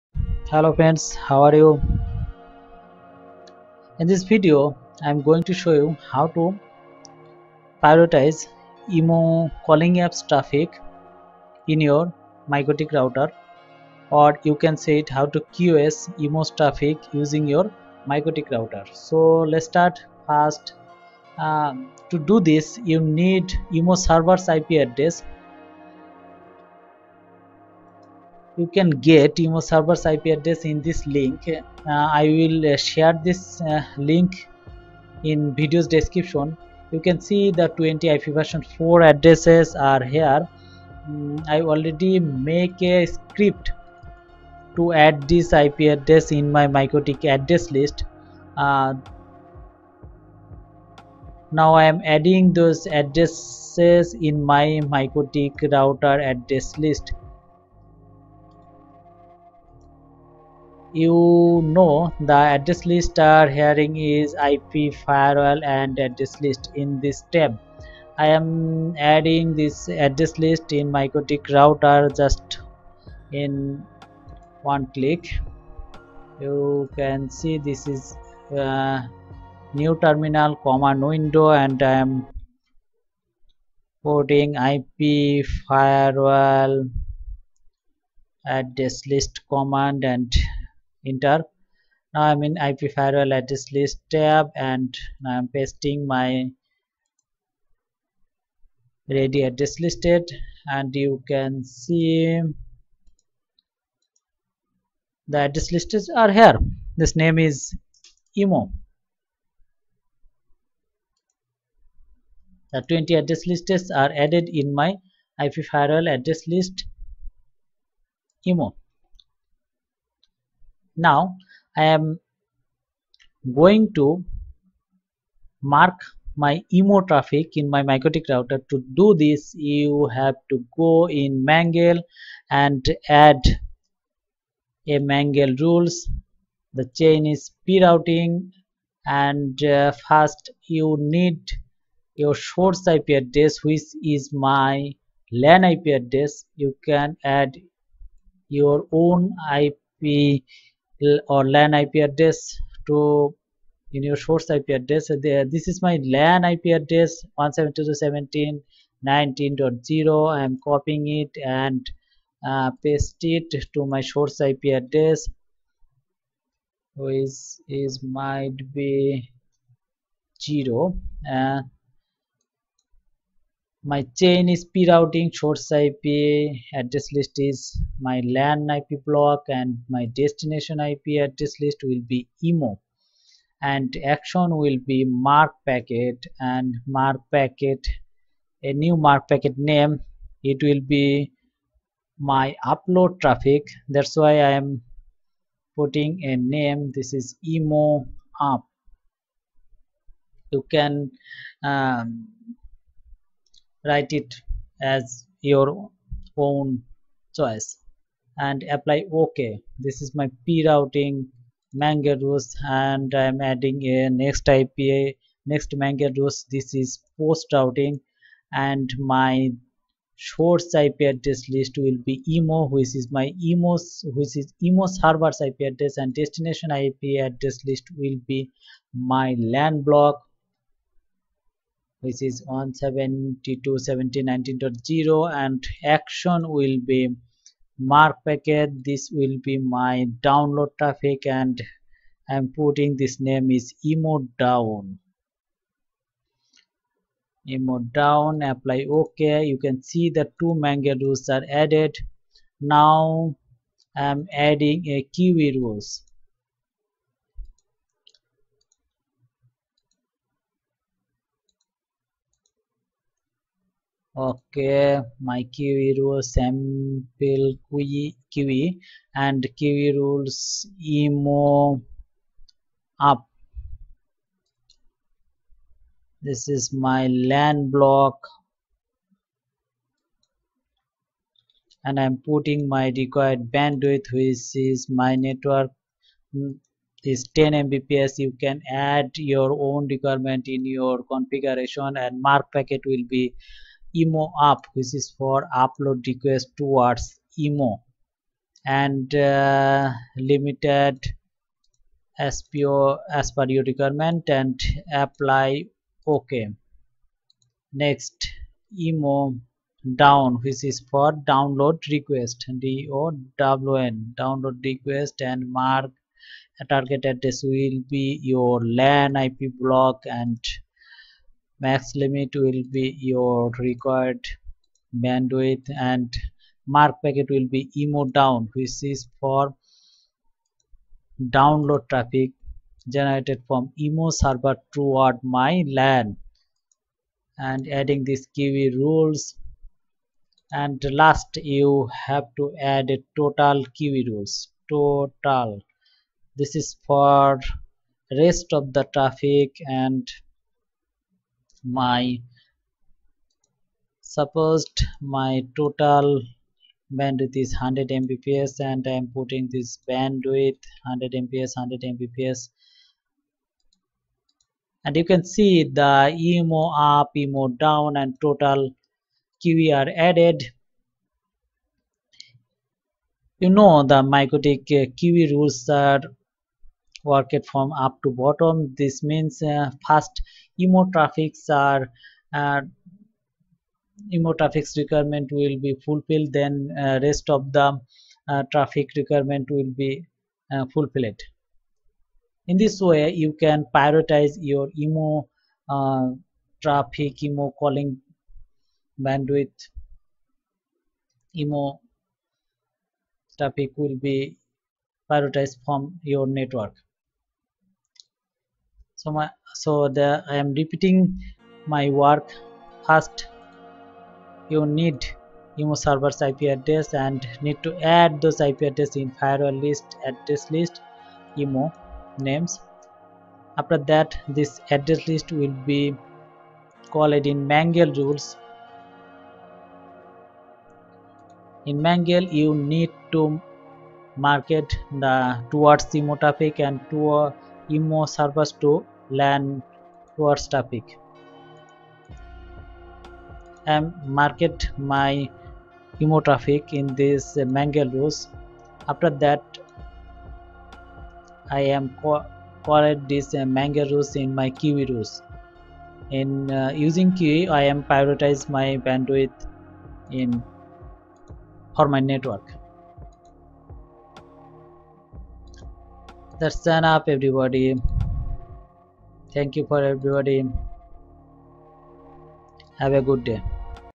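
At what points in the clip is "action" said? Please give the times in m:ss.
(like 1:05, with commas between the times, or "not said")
3:04, 3:55.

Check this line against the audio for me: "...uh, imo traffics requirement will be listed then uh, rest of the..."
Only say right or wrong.
wrong.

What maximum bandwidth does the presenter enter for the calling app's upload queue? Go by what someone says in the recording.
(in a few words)
10 Mbps.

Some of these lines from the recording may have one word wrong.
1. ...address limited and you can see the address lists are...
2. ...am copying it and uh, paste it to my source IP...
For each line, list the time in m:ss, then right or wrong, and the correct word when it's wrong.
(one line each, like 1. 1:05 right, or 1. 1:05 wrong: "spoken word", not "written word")
1. 1:39 wrong: "listed", not "limited"
2. 2:40 right.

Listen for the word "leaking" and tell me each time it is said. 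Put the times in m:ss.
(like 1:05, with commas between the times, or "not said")
not said.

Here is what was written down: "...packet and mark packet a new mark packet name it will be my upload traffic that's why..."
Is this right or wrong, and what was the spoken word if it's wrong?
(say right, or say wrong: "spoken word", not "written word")
right.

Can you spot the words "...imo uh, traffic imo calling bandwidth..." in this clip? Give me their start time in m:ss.
6:34.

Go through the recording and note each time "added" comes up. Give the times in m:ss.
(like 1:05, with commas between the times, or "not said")
1:54, 4:11, 6:09.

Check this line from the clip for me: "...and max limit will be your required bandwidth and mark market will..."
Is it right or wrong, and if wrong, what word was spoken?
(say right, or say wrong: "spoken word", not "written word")
wrong: "packet", not "market".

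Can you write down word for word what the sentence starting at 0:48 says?
Uh, now I am adding those addresses in my MikroTik router address list.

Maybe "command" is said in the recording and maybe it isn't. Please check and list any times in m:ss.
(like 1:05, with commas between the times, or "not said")
1:20, 1:29.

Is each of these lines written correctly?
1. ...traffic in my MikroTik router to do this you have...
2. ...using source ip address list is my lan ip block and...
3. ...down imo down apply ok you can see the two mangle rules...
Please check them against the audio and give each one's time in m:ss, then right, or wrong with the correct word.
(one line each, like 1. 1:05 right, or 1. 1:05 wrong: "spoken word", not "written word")
1. 2:07 right
2. 2:54 wrong: "prerouting", not "using"
3. 4:04 right.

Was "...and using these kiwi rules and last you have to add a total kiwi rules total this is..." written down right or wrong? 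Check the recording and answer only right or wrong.
wrong.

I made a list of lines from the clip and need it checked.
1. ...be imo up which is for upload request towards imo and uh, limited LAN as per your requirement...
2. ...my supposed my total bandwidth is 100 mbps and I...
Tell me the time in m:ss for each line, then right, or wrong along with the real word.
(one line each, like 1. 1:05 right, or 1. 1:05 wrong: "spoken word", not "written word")
1. 4:53 wrong: "SPO", not "LAN"
2. 5:51 right.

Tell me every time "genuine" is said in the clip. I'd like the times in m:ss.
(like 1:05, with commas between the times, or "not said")
not said.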